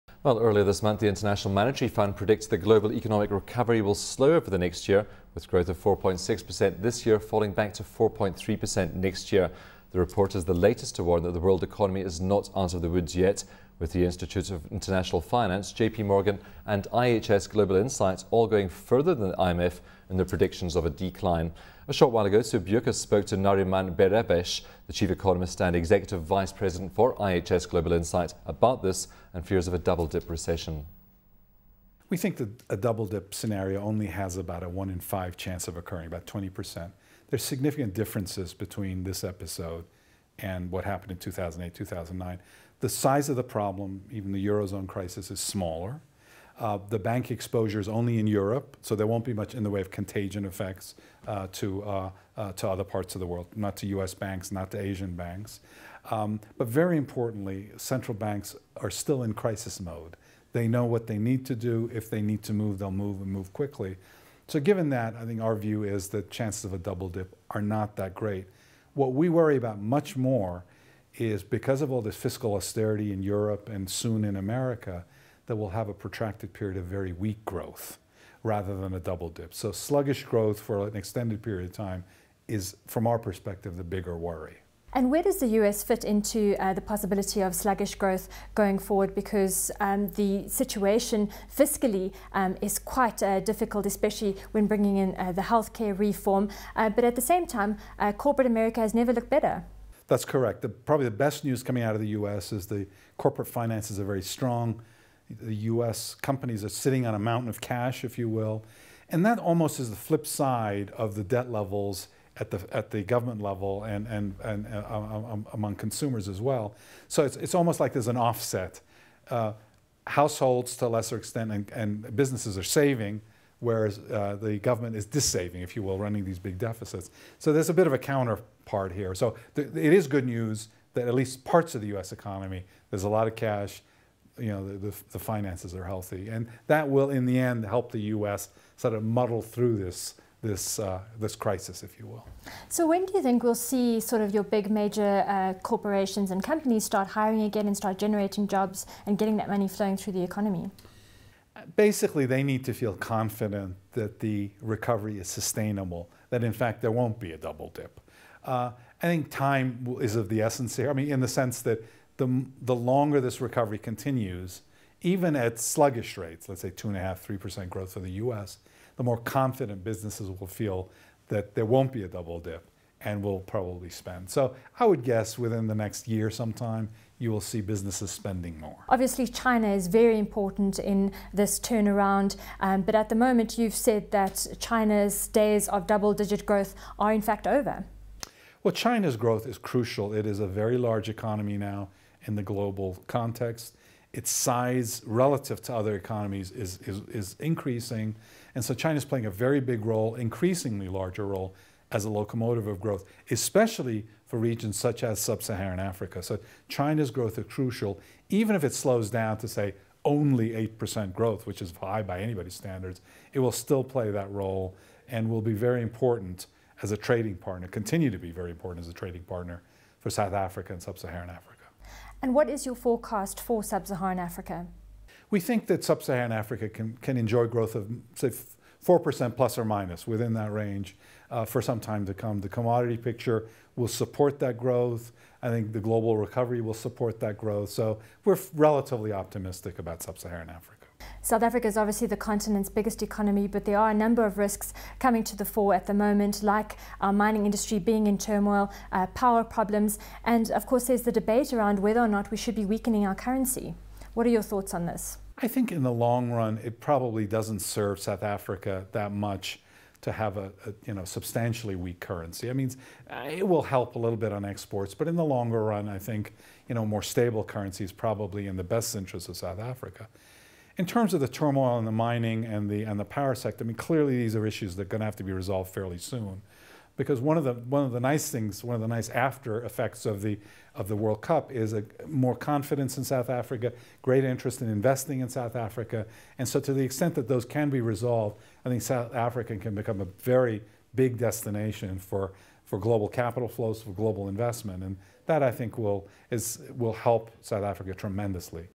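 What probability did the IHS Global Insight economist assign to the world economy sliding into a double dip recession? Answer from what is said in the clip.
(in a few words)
20%.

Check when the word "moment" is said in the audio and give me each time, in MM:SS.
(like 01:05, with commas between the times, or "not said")
03:03, 04:05.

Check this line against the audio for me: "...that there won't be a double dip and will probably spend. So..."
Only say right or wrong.
right.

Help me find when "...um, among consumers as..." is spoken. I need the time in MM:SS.
01:55.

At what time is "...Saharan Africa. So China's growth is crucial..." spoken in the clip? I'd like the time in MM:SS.
03:25.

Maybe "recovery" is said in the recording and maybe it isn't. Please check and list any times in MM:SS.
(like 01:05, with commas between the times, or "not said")
00:03, 02:34, 02:43, 03:56.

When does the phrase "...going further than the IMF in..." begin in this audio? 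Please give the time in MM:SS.
00:18.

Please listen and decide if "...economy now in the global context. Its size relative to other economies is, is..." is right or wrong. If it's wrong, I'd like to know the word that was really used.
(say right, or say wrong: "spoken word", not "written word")
right.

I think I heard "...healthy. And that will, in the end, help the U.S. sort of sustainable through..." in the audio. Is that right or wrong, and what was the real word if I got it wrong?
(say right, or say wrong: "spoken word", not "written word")
wrong: "muddle", not "sustainable".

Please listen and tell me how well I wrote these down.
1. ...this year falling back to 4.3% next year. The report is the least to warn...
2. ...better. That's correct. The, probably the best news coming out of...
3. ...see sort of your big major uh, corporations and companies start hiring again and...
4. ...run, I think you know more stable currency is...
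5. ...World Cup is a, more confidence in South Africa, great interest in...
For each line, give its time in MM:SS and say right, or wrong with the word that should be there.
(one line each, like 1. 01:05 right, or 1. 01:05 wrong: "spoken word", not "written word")
1. 00:06 wrong: "latest", not "least"
2. 01:39 right
3. 02:23 right
4. 04:25 right
5. 04:40 right.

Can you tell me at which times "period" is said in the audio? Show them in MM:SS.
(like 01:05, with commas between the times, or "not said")
01:16, 01:21.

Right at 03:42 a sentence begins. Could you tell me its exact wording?
And what is your forecast for sub Saharan Africa?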